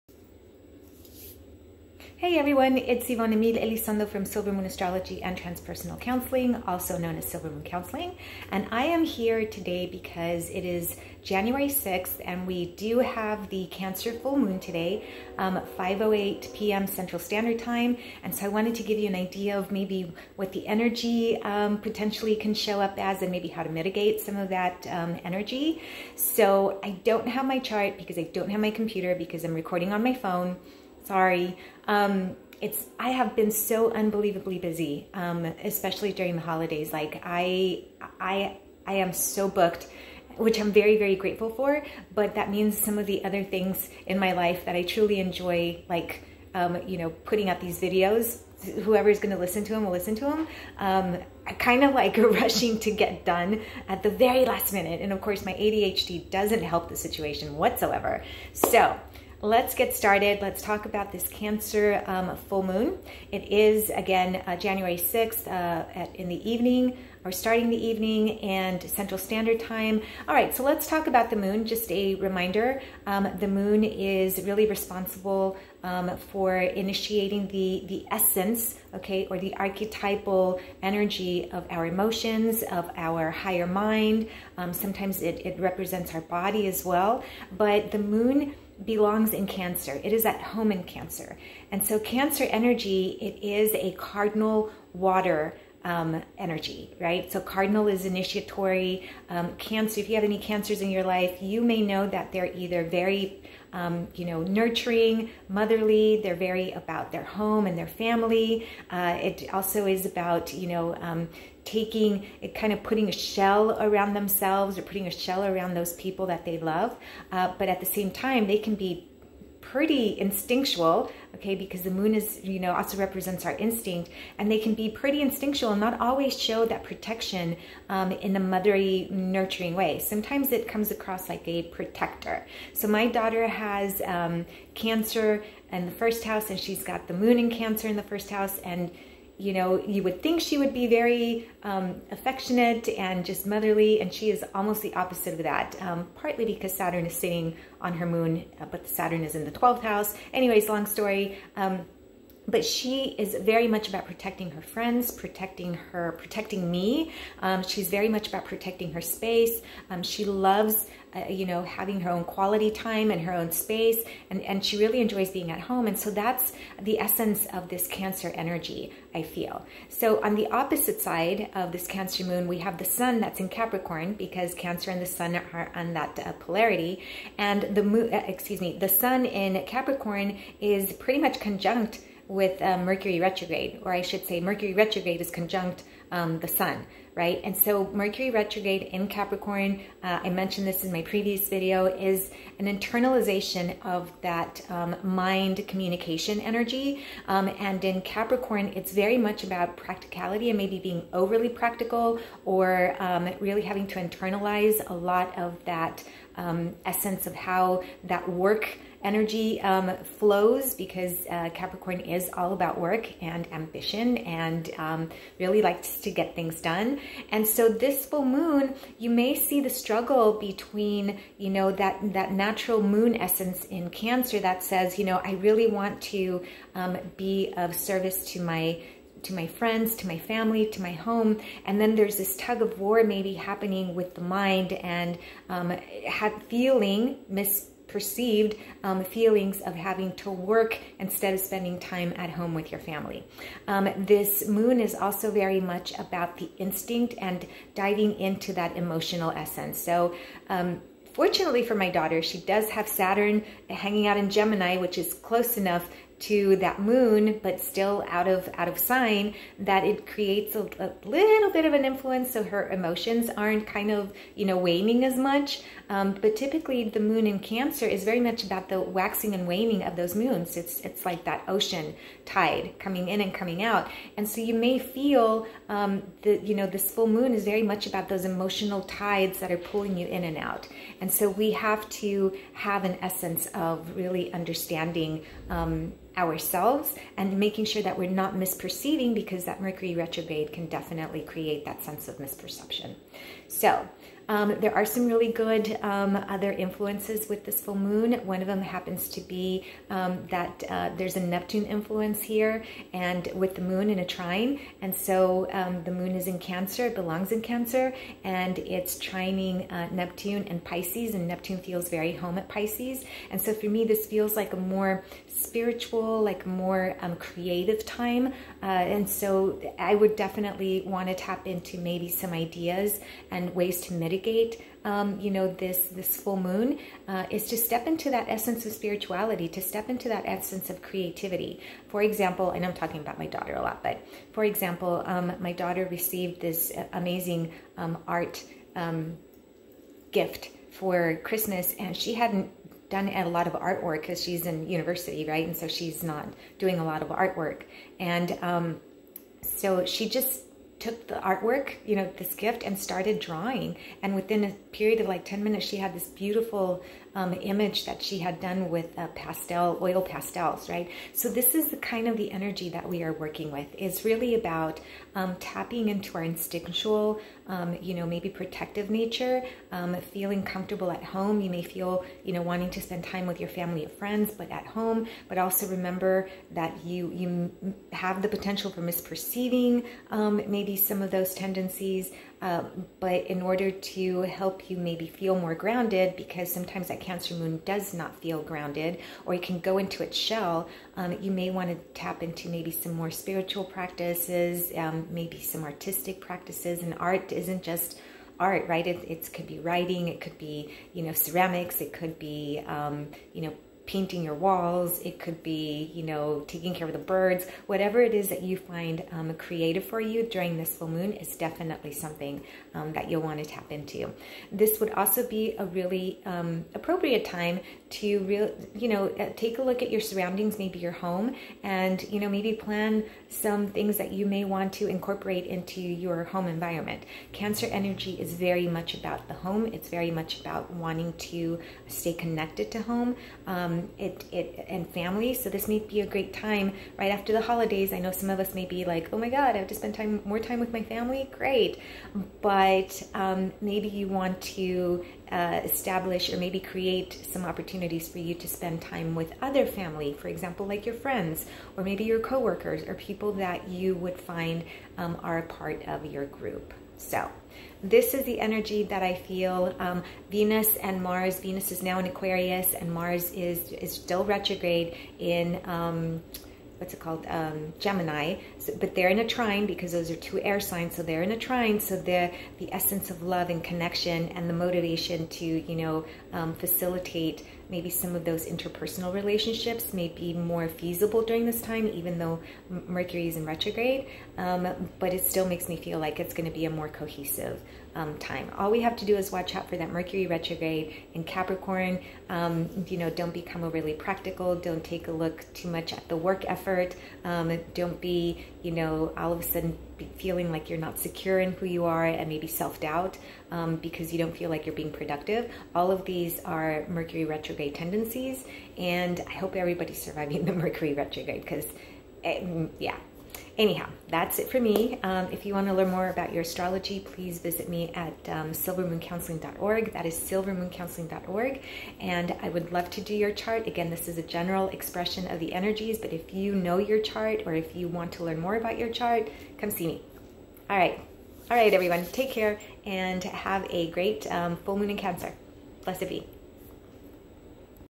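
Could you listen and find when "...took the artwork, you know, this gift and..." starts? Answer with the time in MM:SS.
05:50.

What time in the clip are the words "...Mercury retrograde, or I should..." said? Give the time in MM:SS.
03:02.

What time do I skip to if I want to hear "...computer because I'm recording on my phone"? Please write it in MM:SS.
00:28.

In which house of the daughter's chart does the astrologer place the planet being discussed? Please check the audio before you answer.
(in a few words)
12th house.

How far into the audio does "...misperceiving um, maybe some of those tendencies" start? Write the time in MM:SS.
06:18.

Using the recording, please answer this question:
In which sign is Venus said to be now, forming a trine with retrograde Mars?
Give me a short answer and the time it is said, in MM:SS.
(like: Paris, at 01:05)
Aquarius, at 07:42.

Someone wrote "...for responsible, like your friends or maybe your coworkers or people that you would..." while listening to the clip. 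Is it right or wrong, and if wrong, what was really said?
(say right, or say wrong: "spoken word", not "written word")
wrong: "example", not "responsible".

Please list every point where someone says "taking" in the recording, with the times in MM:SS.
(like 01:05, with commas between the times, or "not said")
01:51, 06:46.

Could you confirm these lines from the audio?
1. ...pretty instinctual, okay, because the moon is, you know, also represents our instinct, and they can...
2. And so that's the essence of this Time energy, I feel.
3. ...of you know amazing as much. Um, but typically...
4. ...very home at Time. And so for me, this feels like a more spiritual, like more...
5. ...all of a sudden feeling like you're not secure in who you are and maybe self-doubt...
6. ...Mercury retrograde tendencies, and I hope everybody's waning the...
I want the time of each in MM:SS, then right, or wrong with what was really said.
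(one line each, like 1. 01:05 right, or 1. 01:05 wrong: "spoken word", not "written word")
1. 01:59 right
2. 02:45 wrong: "Cancer", not "Time"
3. 04:23 wrong: "waning", not "amazing"
4. 05:11 wrong: "Pisces", not "Time"
5. 08:19 right
6. 08:26 wrong: "surviving", not "waning".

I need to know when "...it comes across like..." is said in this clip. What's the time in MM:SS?
02:10.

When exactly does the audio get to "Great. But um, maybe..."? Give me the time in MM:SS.
07:21.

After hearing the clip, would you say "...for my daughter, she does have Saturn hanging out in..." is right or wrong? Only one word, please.
right.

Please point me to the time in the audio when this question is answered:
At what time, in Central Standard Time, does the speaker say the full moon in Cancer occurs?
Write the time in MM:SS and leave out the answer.
00:15.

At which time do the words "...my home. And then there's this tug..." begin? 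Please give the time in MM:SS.
03:50.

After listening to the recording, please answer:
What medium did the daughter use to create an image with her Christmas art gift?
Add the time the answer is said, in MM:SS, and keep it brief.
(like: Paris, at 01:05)
oil pastels, at 05:59.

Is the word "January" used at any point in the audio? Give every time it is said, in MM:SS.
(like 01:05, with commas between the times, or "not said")
00:11, 01:04.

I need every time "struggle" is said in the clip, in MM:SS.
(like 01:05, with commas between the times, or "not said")
03:39.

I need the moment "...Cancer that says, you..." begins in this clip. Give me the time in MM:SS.
03:43.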